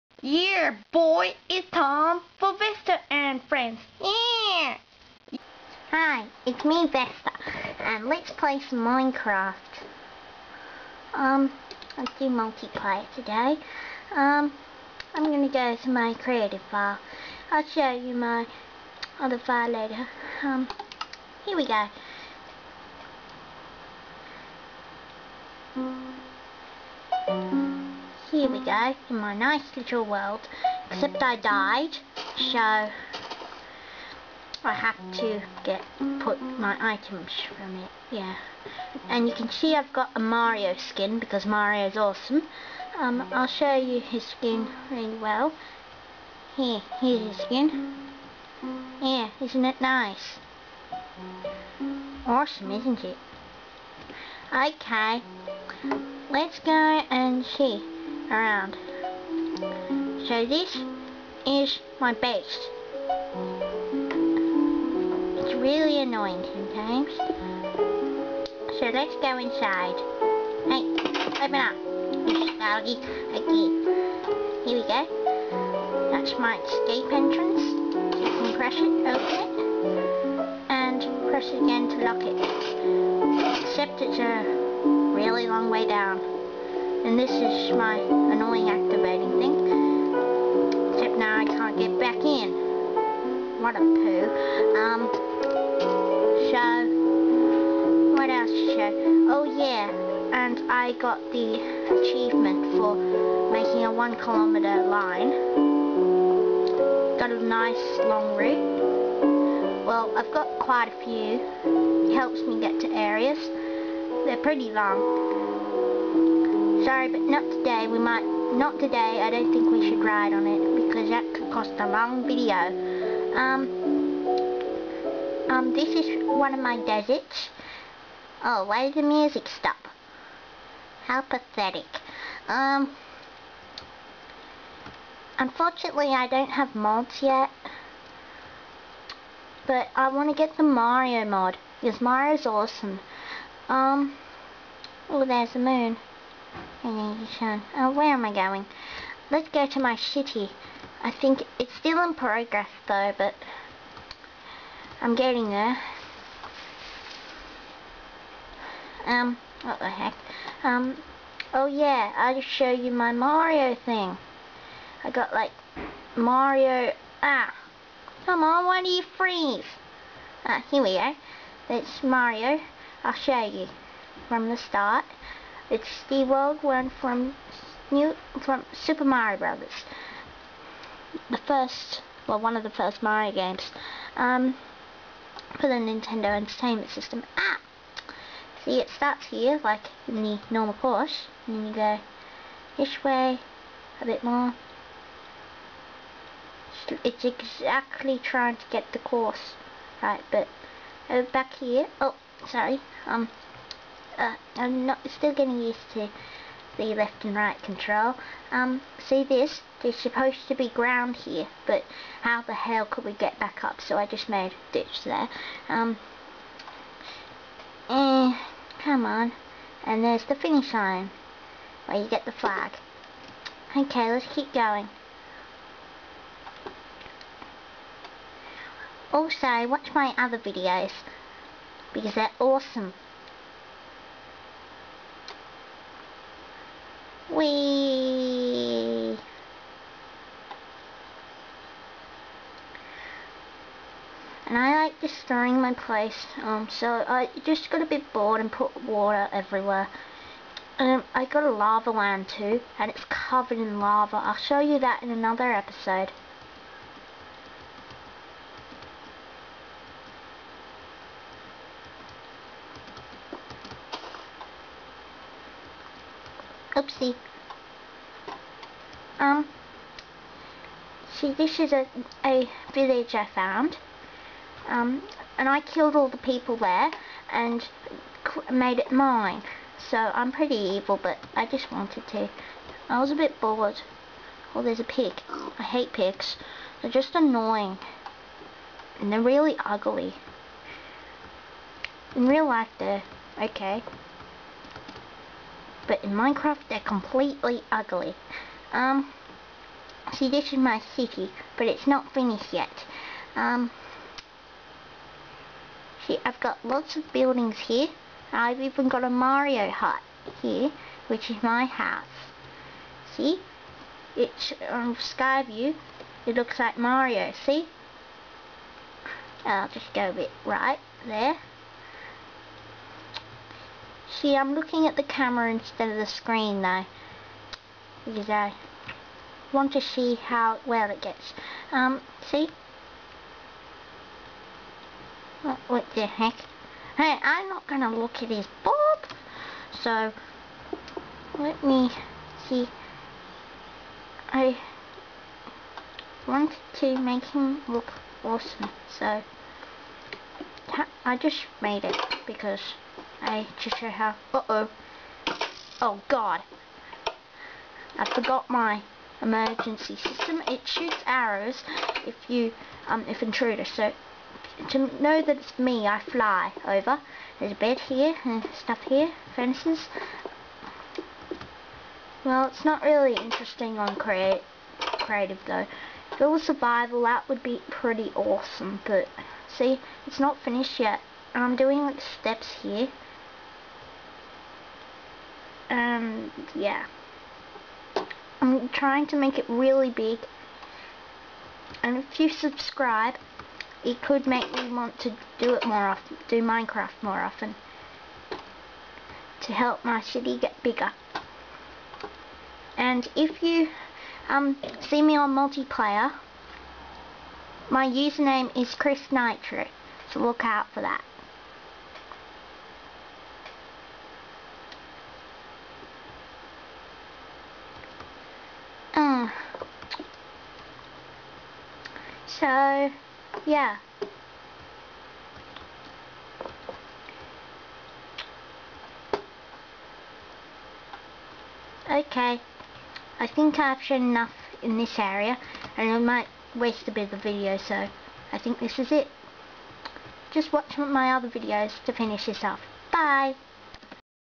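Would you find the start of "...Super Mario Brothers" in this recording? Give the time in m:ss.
2:58.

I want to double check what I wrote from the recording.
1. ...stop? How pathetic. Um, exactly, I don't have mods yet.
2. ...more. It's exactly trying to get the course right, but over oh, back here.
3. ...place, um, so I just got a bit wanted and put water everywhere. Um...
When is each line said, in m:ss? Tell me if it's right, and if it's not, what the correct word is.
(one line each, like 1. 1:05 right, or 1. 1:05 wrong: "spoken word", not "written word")
1. 2:09 wrong: "unfortunately", not "exactly"
2. 3:14 right
3. 4:05 wrong: "bored", not "wanted".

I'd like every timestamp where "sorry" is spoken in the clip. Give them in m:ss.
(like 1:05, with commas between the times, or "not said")
1:56, 3:22.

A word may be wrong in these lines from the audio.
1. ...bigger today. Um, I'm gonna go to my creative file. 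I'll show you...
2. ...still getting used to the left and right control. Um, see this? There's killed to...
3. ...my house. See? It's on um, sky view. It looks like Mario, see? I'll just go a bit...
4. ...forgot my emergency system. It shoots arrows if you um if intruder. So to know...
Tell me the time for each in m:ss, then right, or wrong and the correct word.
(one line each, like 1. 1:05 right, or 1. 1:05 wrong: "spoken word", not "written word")
1. 0:12 wrong: "multiplayer", not "bigger"
2. 3:25 wrong: "supposed", not "killed"
3. 5:11 right
4. 5:58 right.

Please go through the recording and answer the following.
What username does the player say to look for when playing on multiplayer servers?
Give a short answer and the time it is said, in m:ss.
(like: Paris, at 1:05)
Chris Nitro, at 6:48.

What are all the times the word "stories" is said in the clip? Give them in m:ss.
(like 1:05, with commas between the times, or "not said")
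not said.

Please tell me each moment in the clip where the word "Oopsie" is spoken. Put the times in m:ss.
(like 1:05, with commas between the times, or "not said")
4:26.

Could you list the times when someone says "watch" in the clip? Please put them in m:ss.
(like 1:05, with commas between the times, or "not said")
3:49, 7:20.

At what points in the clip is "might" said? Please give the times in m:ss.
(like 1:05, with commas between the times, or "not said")
1:57, 7:15.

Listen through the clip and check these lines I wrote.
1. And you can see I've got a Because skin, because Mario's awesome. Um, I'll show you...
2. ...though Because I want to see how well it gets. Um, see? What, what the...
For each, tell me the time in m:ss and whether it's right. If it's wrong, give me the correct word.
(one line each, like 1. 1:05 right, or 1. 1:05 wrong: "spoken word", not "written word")
1. 0:39 wrong: "Mario", not "Because"
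2. 5:26 right.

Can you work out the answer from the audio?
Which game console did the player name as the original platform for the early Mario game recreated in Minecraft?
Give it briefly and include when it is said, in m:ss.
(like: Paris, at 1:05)
Nintendo Entertainment System, at 3:05.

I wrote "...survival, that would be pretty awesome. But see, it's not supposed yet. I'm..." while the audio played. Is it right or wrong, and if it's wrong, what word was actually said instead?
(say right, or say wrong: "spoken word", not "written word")
wrong: "finished", not "supposed".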